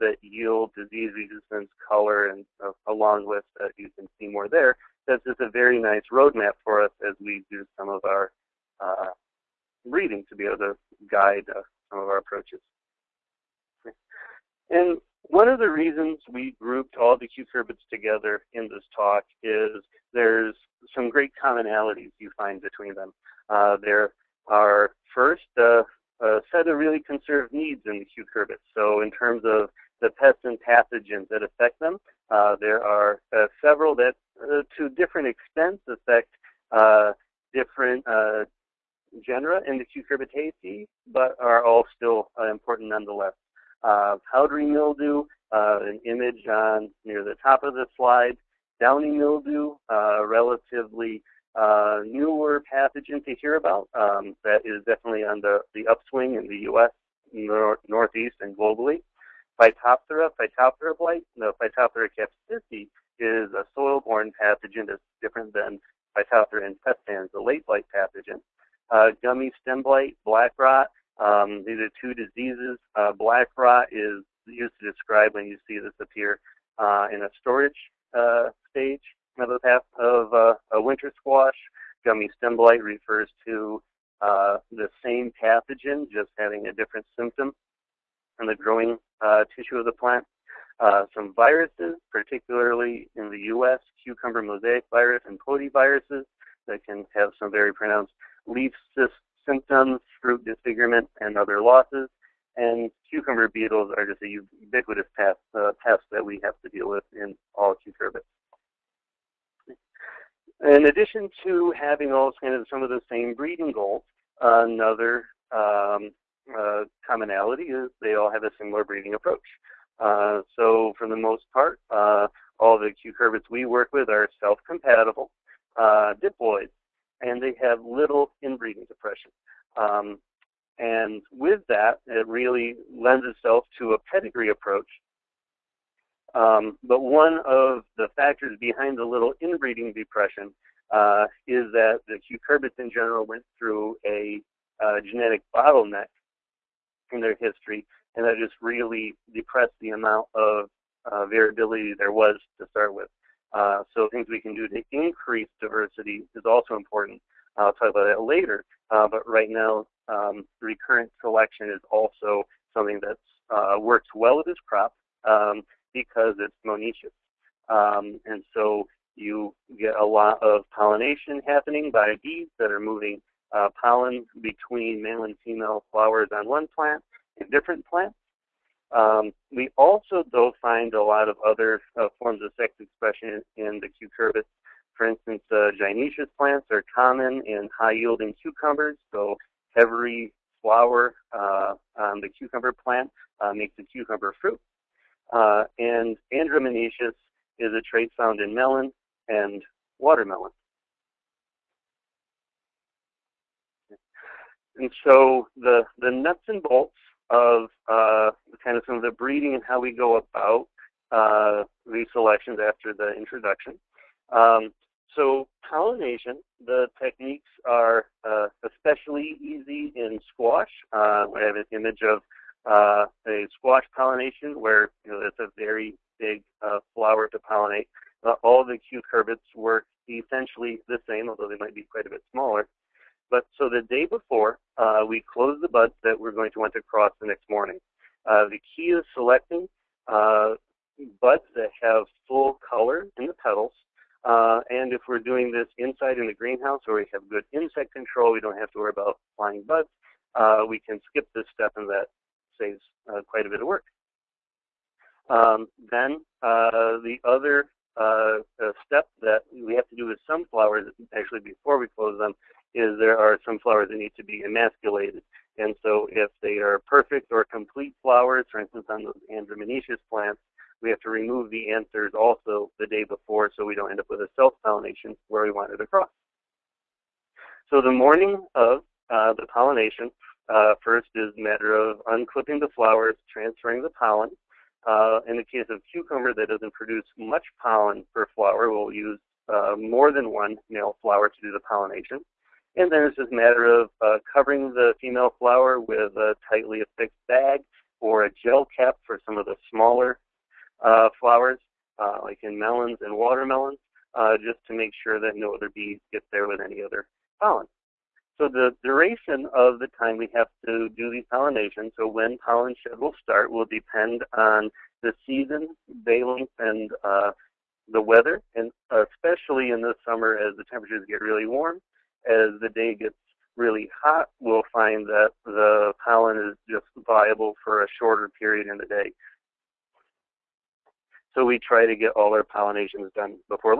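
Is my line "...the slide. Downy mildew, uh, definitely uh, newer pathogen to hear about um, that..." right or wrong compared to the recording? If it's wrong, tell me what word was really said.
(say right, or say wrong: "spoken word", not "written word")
wrong: "relatively", not "definitely".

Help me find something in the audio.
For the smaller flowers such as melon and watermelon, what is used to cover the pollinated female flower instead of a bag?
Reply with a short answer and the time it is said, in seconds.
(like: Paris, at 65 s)
A gel cap, at 298 s.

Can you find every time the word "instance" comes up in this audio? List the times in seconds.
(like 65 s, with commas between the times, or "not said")
185 s, 268 s.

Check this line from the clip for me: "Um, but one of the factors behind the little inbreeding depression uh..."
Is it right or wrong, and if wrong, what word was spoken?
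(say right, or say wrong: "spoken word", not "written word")
right.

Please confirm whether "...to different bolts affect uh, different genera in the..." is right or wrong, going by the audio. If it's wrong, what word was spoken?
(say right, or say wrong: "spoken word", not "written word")
wrong: "extents", not "bolts".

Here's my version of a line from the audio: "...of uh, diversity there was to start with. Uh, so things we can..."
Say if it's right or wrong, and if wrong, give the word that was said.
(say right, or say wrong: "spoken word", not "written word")
wrong: "variability", not "diversity".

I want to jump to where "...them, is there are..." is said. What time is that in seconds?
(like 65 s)
262 s.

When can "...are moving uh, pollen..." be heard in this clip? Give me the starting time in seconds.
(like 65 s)
172 s.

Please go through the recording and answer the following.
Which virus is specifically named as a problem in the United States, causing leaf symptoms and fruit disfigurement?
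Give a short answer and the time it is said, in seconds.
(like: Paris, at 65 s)
Cucumber mosaic virus, at 94 s.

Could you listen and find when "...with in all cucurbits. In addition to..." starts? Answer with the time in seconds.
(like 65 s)
106 s.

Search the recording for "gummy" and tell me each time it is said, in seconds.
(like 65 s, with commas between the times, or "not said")
69 s, 82 s.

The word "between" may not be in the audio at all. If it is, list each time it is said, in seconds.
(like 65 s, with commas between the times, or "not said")
22 s, 174 s.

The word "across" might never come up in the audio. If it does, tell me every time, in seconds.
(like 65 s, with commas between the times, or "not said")
275 s.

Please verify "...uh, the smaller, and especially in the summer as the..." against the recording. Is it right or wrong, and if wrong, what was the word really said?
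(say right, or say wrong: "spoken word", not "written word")
wrong: "weather", not "smaller".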